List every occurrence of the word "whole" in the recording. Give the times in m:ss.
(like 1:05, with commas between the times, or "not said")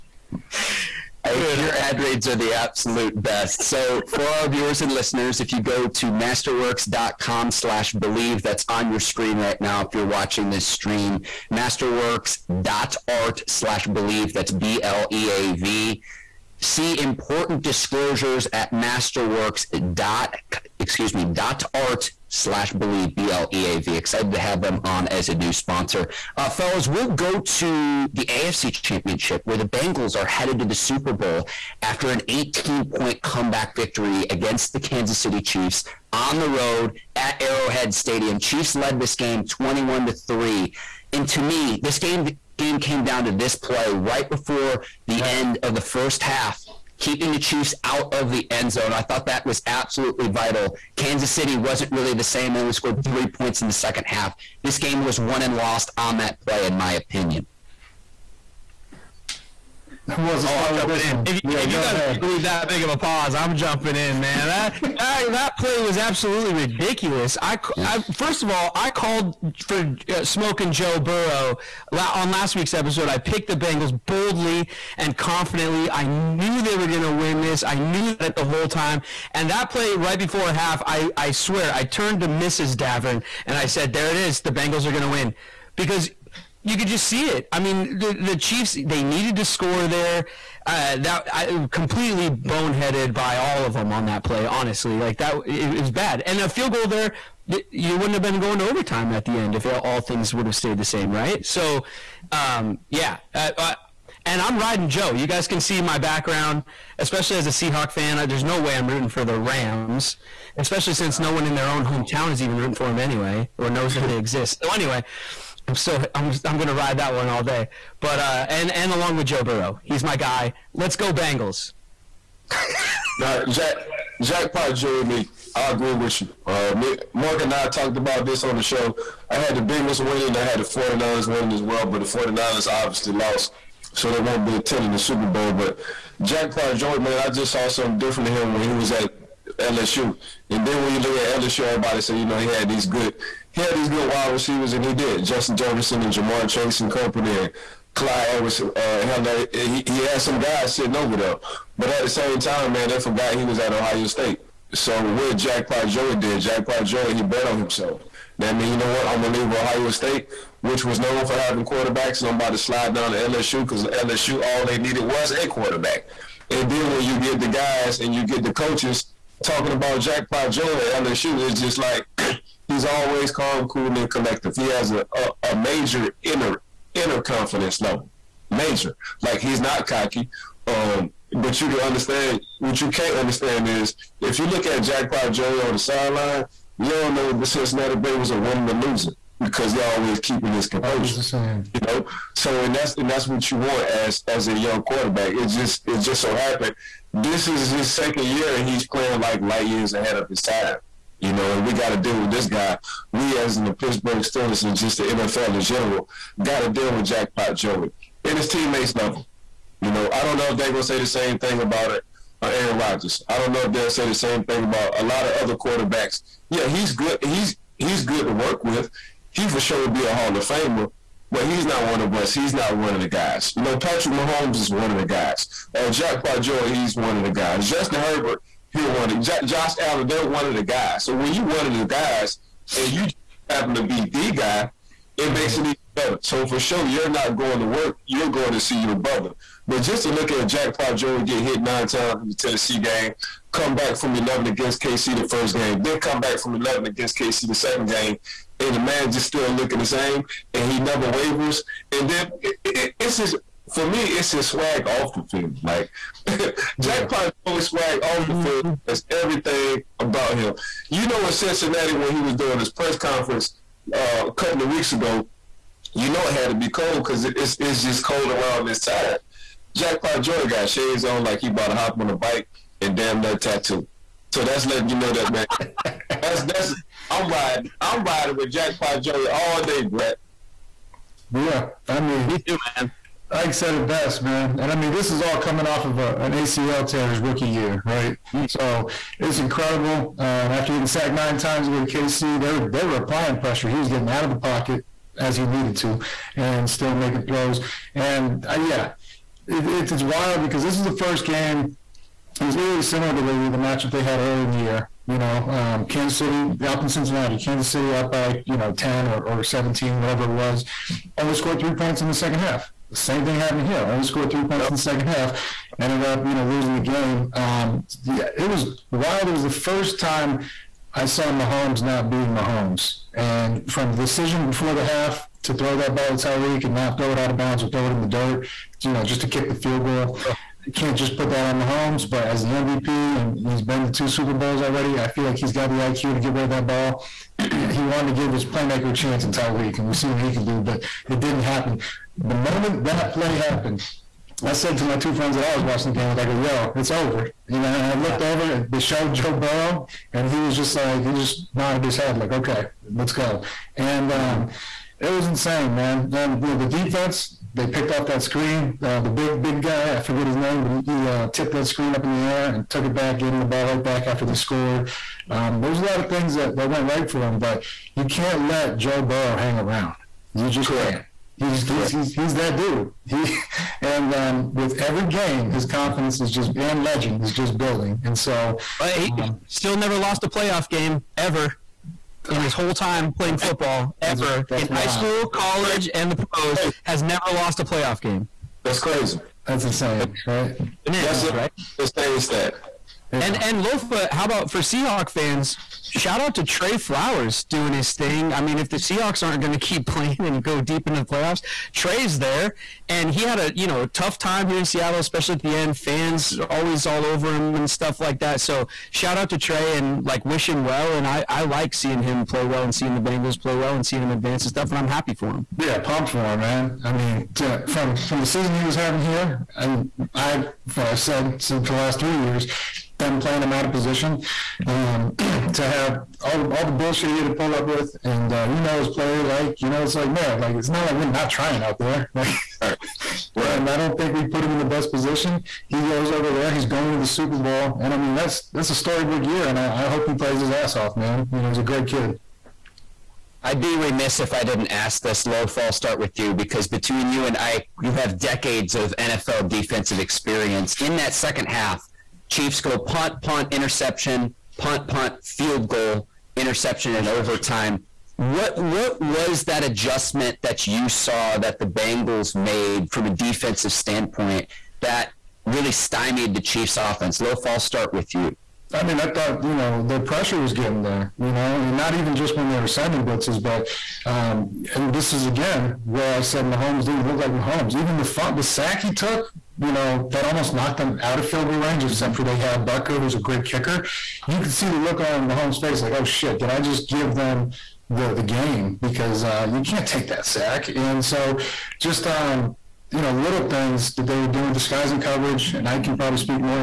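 1:18, 6:22.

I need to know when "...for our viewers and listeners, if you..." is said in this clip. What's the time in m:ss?
0:04.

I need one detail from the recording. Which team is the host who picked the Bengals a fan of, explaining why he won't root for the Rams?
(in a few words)
Seahawks.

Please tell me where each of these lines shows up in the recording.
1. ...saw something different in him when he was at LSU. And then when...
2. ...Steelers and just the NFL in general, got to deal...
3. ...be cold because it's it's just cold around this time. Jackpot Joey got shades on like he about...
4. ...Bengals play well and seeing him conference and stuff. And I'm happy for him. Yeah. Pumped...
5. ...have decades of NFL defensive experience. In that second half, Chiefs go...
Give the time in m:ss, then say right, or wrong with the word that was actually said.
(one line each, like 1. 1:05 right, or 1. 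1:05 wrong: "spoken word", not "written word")
1. 2:17 right
2. 3:24 right
3. 4:26 right
4. 6:53 wrong: "advance", not "conference"
5. 7:27 right.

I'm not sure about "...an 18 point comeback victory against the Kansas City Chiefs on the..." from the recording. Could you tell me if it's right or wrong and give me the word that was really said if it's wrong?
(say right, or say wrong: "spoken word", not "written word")
right.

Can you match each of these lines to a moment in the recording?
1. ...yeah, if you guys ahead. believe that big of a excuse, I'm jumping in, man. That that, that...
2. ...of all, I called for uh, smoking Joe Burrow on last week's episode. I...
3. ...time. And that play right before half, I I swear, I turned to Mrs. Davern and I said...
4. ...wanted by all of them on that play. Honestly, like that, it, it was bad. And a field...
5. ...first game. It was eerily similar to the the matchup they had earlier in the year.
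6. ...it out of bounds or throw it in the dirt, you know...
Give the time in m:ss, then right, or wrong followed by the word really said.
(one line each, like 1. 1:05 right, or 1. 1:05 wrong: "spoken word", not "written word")
1. 1:01 wrong: "pause", not "excuse"
2. 1:08 right
3. 1:18 right
4. 1:32 wrong: "boneheaded", not "wanted"
5. 5:00 right
6. 5:27 right.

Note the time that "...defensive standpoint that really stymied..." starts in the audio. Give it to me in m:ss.
7:43.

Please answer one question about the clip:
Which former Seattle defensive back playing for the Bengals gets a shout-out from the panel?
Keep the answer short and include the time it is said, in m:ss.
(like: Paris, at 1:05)
Tre Flowers, at 6:36.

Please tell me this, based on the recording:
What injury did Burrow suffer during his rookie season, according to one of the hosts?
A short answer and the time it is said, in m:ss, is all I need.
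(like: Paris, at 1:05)
ACL tear, at 4:46.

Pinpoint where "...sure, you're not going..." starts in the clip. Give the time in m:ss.
3:56.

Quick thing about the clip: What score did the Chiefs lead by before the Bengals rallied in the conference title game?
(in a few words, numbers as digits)
21 to 3.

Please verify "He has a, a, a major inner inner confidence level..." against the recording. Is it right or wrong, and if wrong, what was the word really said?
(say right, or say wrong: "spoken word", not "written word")
right.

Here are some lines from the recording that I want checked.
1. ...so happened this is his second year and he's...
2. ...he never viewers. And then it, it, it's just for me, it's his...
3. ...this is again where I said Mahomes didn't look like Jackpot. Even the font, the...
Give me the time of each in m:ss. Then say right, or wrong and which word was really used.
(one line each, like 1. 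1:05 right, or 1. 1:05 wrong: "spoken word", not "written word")
1. 3:16 right
2. 4:10 wrong: "wavers", not "viewers"
3. 7:54 wrong: "Mahomes", not "Jackpot".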